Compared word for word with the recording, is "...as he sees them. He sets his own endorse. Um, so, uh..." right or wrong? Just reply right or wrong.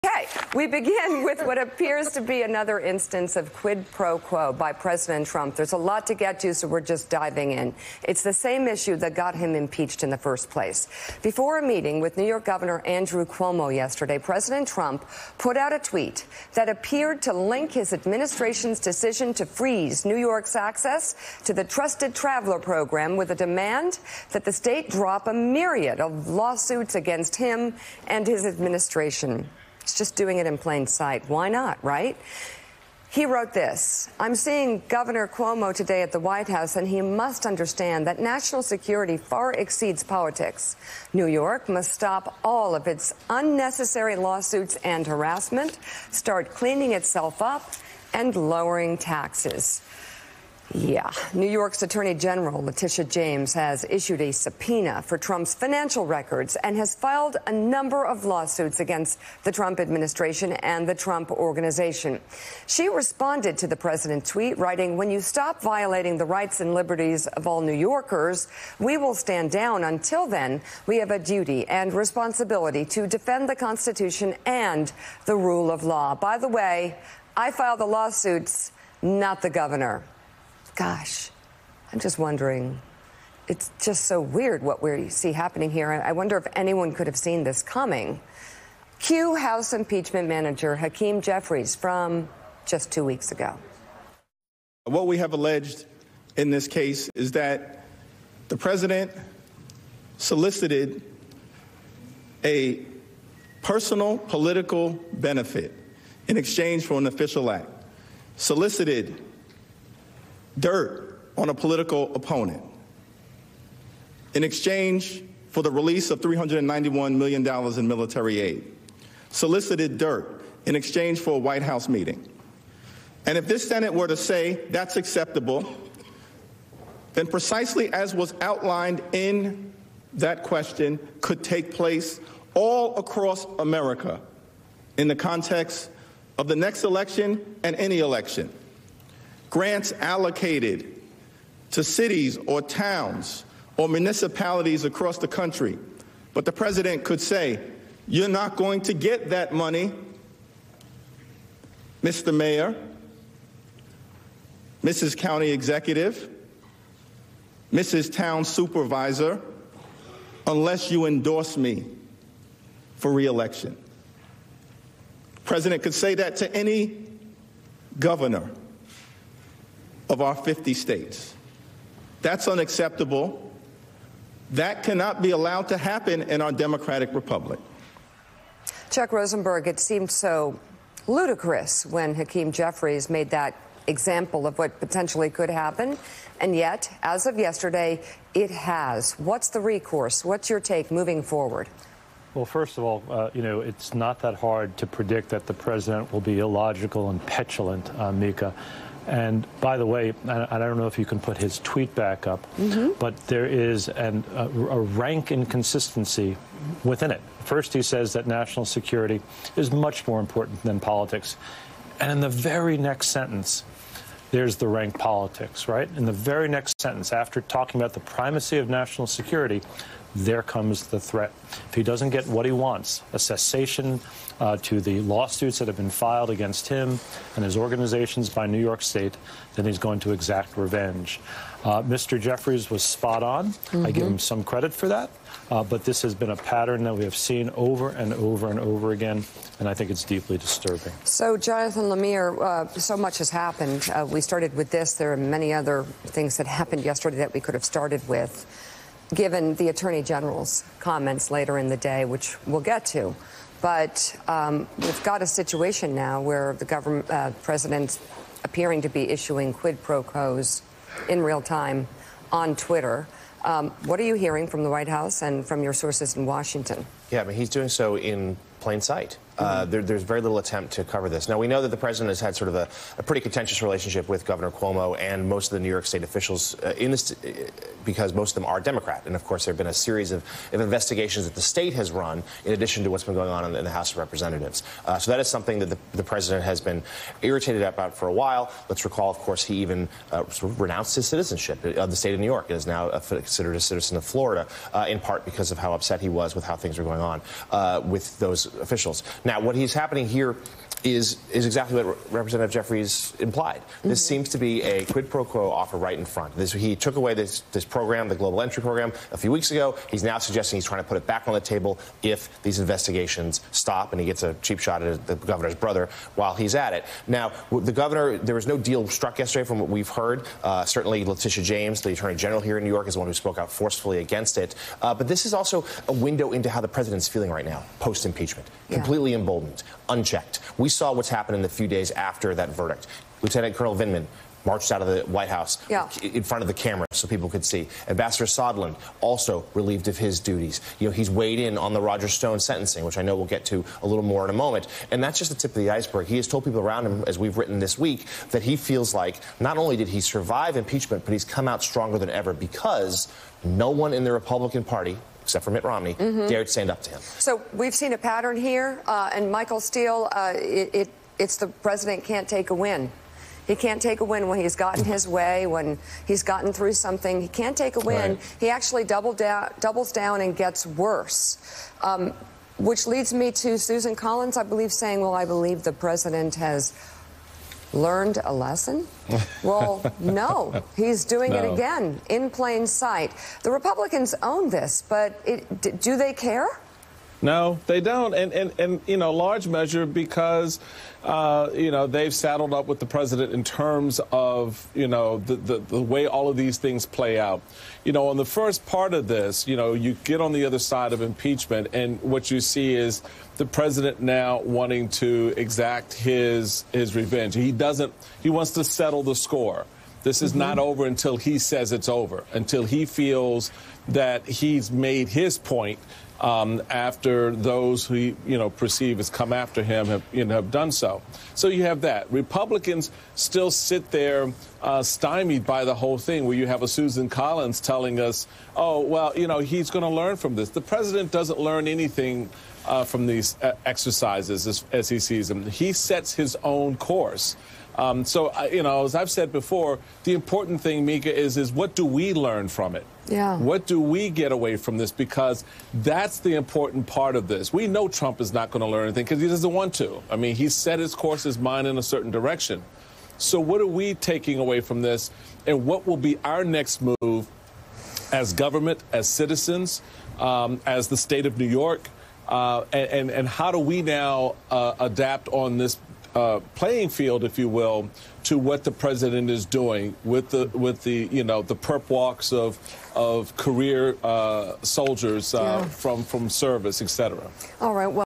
wrong.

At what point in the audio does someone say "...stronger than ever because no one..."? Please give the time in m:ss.
5:51.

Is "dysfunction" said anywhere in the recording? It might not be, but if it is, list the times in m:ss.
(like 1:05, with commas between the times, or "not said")
not said.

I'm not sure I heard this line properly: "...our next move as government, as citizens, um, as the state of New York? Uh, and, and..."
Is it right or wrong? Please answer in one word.
right.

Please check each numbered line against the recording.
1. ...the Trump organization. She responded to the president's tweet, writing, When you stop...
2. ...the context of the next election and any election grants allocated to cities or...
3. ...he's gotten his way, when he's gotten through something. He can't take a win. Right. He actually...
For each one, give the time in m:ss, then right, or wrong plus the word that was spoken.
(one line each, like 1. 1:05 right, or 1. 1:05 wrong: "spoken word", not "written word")
1. 1:00 right
2. 2:15 right
3. 6:04 right.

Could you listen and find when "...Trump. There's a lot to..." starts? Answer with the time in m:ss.
0:05.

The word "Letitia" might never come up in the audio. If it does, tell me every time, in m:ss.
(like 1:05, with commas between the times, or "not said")
0:52, 5:21.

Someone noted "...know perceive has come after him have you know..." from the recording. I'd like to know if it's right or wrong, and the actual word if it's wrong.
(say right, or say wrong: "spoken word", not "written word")
right.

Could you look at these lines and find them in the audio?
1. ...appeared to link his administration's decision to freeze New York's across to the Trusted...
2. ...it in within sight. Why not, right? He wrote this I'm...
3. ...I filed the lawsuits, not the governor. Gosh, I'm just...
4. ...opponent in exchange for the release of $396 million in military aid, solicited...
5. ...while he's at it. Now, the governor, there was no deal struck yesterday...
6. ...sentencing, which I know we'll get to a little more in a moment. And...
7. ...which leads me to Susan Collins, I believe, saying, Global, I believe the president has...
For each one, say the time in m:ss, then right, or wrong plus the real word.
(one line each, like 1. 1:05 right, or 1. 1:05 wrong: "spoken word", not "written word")
1. 0:16 wrong: "access", not "across"
2. 0:30 wrong: "plain", not "within"
3. 1:17 right
4. 1:52 wrong: "391", not "396"
5. 5:16 right
6. 5:42 right
7. 6:12 wrong: "Well", not "Global".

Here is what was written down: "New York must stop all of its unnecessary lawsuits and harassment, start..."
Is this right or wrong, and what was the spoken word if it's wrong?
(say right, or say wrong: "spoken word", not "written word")
right.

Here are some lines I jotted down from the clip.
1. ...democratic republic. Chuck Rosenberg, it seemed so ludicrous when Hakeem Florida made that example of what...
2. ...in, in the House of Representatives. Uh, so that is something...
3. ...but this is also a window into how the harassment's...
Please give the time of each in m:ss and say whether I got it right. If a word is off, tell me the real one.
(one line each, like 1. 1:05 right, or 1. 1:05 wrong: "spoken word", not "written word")
1. 2:56 wrong: "Jeffries", not "Florida"
2. 4:43 right
3. 5:24 wrong: "president", not "harassment".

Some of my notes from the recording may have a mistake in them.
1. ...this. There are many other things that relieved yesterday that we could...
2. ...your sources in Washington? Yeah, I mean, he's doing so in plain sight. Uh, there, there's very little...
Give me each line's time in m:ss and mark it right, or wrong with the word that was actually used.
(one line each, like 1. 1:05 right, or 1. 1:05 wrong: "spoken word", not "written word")
1. 4:04 wrong: "happened", not "relieved"
2. 4:25 right.